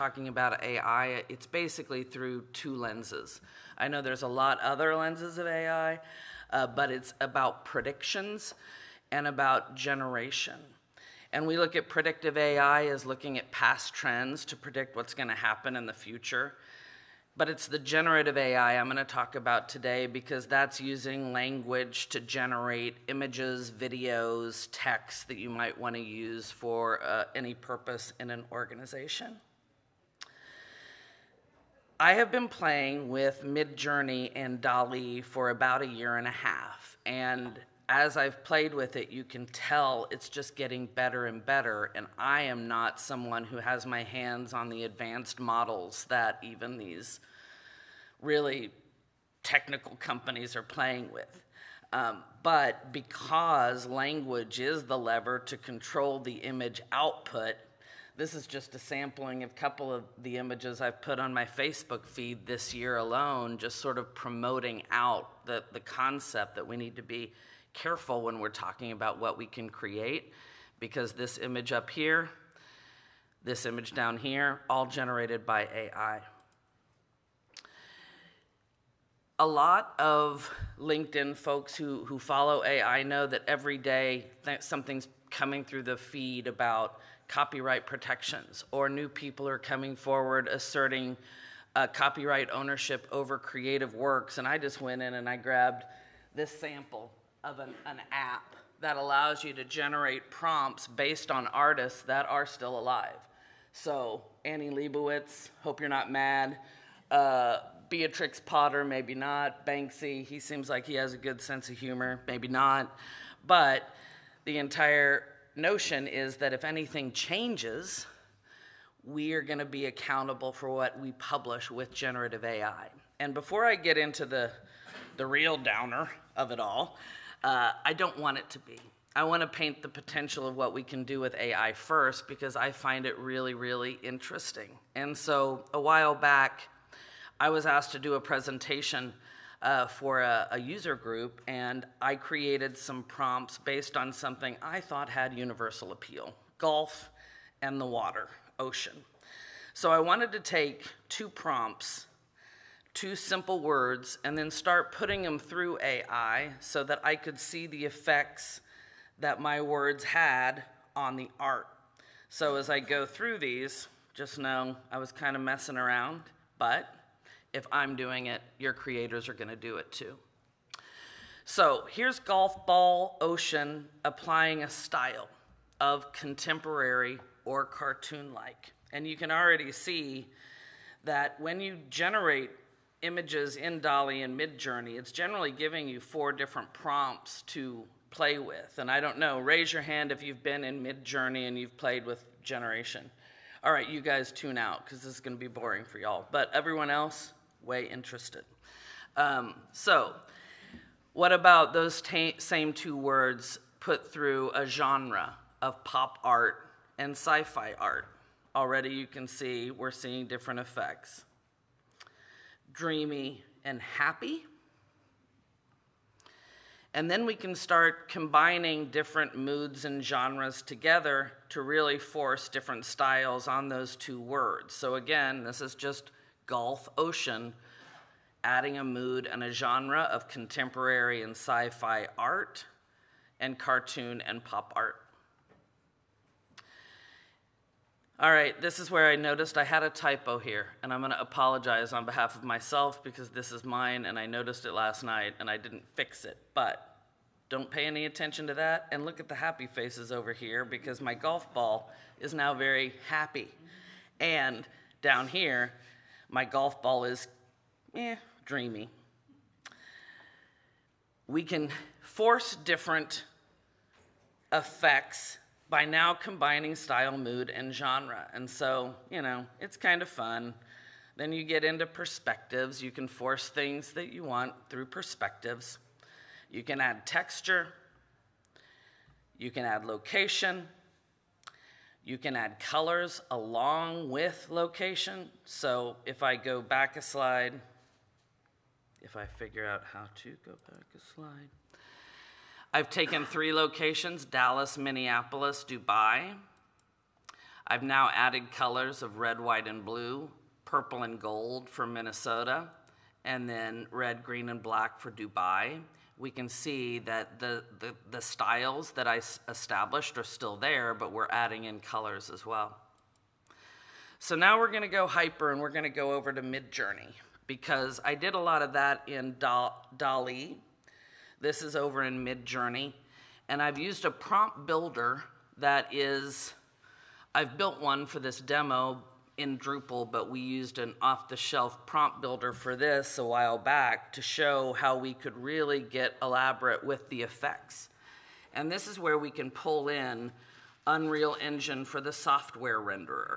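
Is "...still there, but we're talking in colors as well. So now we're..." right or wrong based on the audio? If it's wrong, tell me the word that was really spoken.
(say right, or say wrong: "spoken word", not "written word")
wrong: "adding", not "talking".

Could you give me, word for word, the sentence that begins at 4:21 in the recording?
We can force different effects by now combining style, mood, and genre.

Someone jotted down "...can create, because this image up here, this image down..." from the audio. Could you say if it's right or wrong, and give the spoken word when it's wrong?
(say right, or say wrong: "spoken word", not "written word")
right.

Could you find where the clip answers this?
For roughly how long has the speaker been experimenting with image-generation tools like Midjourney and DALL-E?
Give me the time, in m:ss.
0:35.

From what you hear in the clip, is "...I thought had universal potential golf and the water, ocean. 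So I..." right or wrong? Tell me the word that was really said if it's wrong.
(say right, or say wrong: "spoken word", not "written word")
wrong: "appeal", not "potential".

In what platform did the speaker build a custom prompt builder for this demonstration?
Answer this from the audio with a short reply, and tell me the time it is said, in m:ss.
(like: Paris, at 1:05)
Drupal, at 5:29.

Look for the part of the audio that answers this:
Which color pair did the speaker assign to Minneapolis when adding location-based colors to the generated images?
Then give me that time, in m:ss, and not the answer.
5:00.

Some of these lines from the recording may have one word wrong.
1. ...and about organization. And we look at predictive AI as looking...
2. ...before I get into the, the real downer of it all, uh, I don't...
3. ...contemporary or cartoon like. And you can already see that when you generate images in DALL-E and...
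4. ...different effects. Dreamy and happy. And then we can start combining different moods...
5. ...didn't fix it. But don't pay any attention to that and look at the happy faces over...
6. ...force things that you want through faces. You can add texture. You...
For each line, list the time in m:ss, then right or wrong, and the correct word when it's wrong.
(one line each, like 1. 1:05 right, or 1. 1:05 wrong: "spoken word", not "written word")
1. 0:09 wrong: "generation", not "organization"
2. 2:03 right
3. 2:56 right
4. 3:30 right
5. 4:05 right
6. 4:33 wrong: "perspectives", not "faces".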